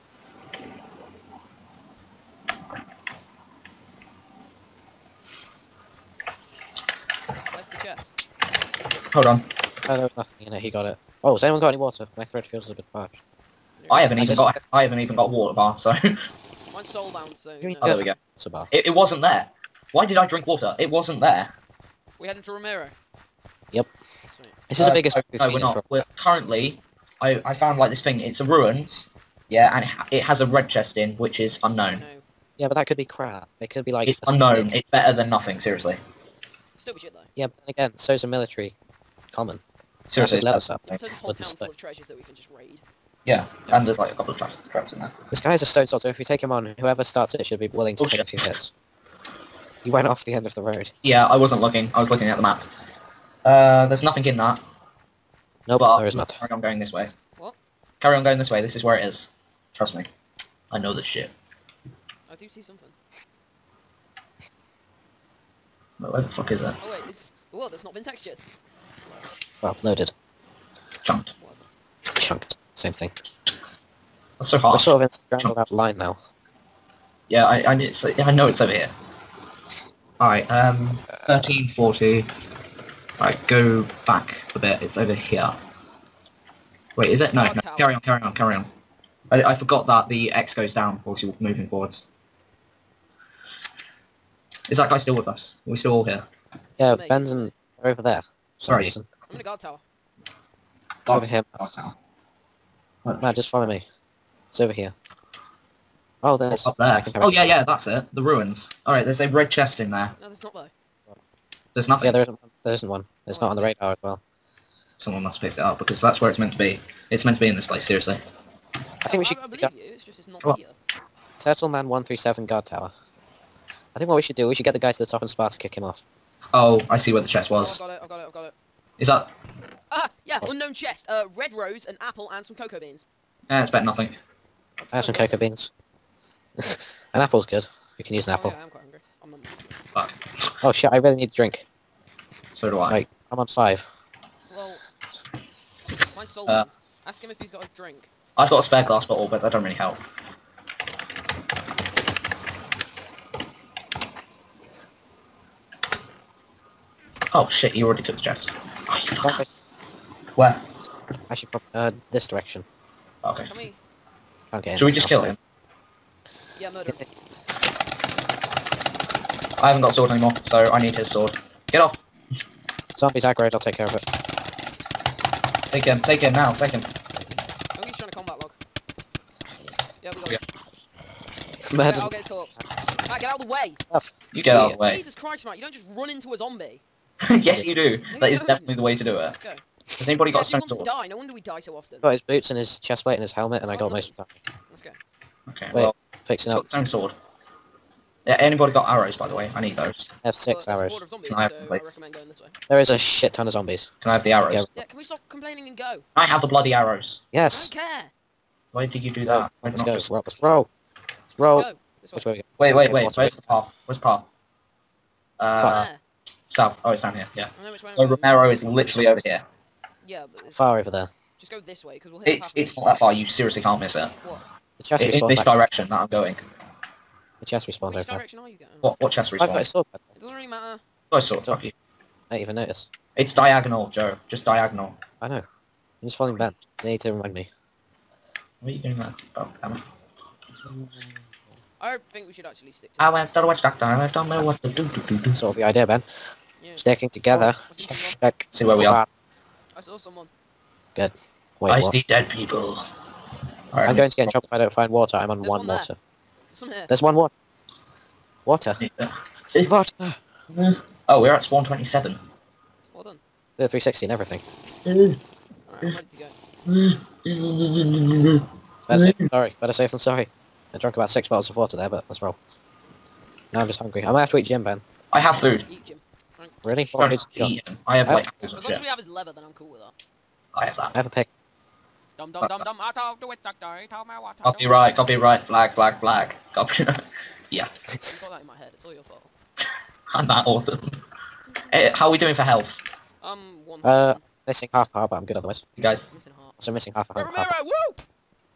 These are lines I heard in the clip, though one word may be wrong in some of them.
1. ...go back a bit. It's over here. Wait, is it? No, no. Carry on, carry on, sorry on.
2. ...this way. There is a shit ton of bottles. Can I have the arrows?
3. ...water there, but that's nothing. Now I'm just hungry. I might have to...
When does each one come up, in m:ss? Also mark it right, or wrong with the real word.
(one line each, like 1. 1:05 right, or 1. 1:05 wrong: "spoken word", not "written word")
1. 1:23 wrong: "carry", not "sorry"
2. 3:22 wrong: "zombies", not "bottles"
3. 4:31 wrong: "wrong", not "nothing".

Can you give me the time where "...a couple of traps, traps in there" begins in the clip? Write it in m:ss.
0:44.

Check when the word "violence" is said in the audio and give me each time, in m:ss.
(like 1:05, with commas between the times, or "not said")
not said.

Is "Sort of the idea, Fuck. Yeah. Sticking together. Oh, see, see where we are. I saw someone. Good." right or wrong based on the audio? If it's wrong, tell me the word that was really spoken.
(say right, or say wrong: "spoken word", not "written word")
wrong: "Ben", not "Fuck".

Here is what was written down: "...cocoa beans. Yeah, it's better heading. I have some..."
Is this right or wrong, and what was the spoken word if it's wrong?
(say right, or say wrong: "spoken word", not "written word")
wrong: "nothing", not "heading".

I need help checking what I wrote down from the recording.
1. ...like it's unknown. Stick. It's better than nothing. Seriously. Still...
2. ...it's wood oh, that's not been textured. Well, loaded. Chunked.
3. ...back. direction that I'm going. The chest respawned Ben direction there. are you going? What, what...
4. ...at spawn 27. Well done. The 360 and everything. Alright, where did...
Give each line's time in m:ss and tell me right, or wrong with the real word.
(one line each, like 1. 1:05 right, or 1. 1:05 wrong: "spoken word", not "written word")
1. 0:33 right
2. 1:07 right
3. 3:45 wrong: "Which", not "Ben"
4. 4:21 right.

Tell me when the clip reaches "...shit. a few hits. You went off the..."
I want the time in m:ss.
0:48.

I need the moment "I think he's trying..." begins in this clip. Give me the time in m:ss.
2:56.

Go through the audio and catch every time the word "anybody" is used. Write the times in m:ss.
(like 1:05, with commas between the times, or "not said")
3:10, 3:18.